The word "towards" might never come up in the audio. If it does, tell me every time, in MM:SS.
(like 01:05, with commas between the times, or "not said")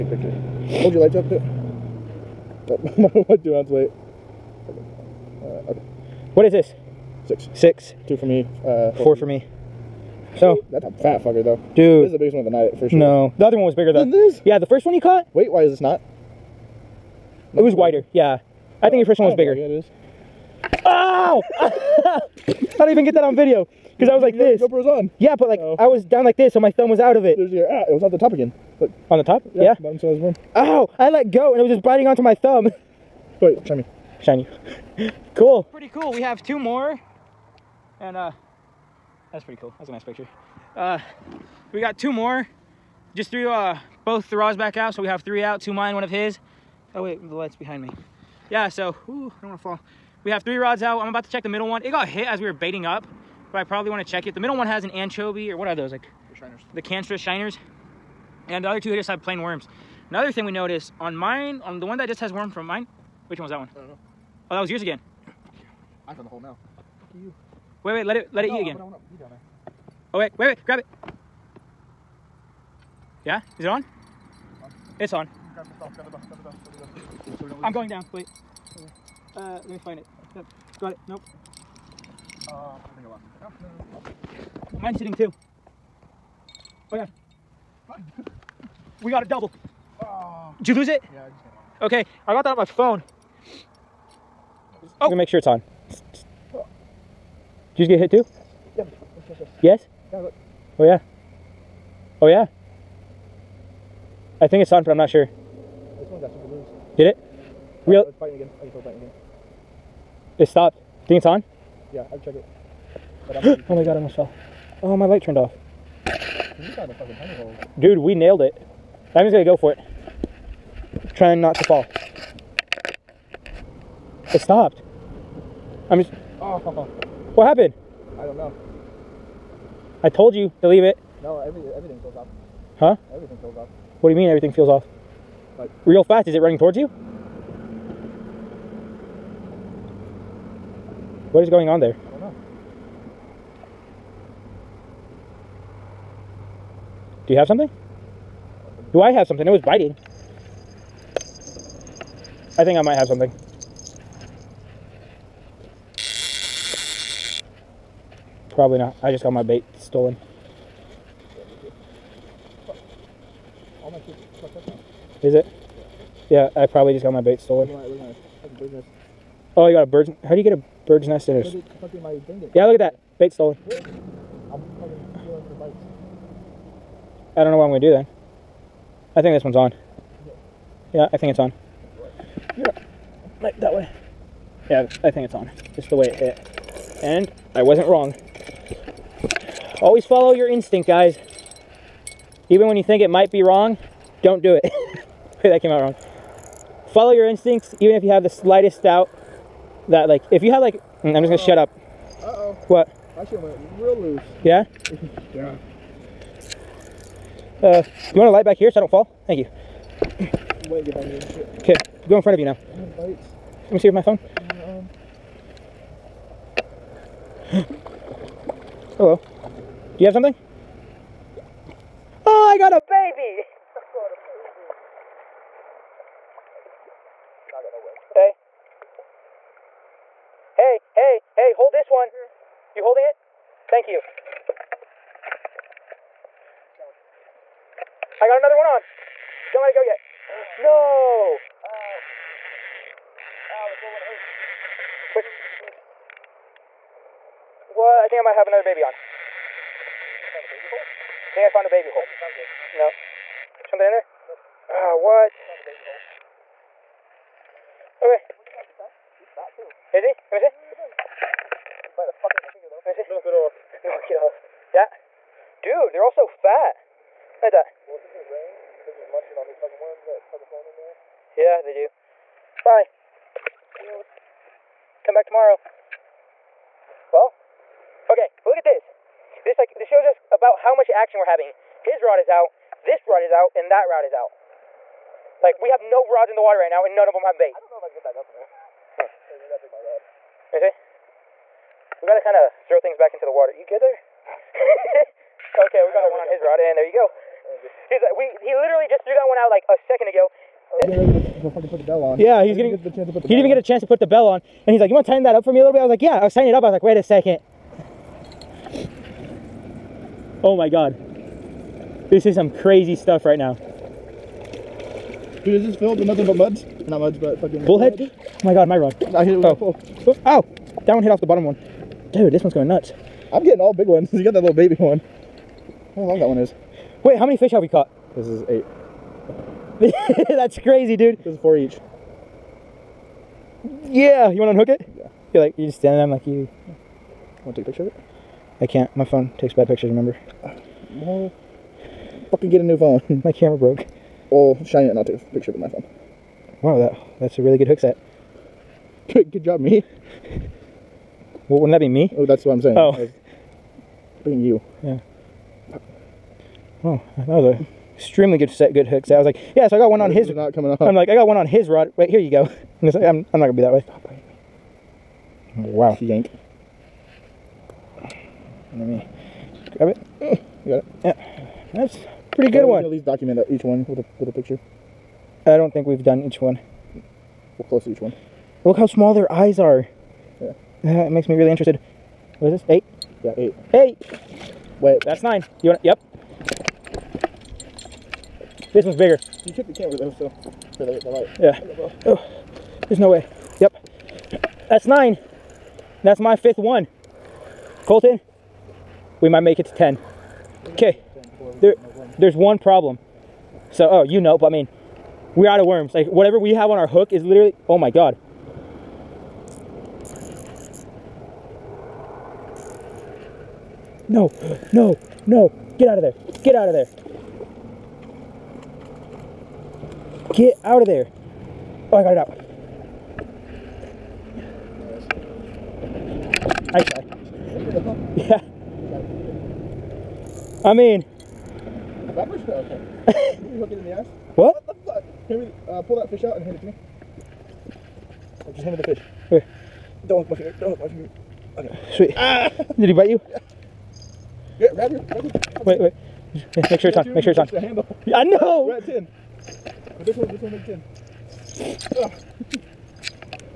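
02:16.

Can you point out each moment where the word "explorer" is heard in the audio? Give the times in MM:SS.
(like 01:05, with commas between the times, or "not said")
not said.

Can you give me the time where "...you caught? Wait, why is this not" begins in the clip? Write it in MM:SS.
00:14.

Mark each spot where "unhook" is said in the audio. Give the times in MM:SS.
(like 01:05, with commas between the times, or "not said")
05:34.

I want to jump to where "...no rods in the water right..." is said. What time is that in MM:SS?
04:45.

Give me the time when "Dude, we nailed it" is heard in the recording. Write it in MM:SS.
01:57.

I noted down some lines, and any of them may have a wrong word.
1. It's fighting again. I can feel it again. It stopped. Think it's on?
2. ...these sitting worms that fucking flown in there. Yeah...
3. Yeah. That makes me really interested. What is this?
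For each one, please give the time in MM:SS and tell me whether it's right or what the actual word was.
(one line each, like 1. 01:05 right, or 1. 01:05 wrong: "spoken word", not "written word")
1. 01:48 right
2. 04:29 wrong: "fucking", not "sitting"
3. 06:20 right.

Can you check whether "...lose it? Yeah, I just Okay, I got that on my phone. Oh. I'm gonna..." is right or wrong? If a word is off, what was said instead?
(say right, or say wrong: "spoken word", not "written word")
right.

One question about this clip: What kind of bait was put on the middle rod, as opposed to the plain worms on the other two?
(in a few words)
Canstra shiners.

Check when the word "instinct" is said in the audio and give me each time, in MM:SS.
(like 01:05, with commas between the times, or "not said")
03:10, 03:17.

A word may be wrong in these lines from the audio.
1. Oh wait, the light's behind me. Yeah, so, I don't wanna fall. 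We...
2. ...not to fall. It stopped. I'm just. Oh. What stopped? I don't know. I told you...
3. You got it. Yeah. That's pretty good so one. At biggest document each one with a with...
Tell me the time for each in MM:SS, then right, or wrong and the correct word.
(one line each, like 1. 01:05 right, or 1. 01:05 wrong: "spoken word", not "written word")
1. 00:46 right
2. 02:01 wrong: "happened", not "stopped"
3. 06:10 wrong: "least", not "biggest".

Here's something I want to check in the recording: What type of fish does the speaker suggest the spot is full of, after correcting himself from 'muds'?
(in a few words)
Bullhead.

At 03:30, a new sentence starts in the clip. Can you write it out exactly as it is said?
Okay, go in front of you now.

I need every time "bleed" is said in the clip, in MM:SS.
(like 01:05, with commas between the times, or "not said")
not said.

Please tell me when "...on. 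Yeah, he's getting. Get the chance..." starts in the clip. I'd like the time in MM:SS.
05:02.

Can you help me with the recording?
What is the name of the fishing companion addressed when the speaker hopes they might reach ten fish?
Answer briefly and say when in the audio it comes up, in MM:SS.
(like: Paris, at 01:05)
Colton, at 06:37.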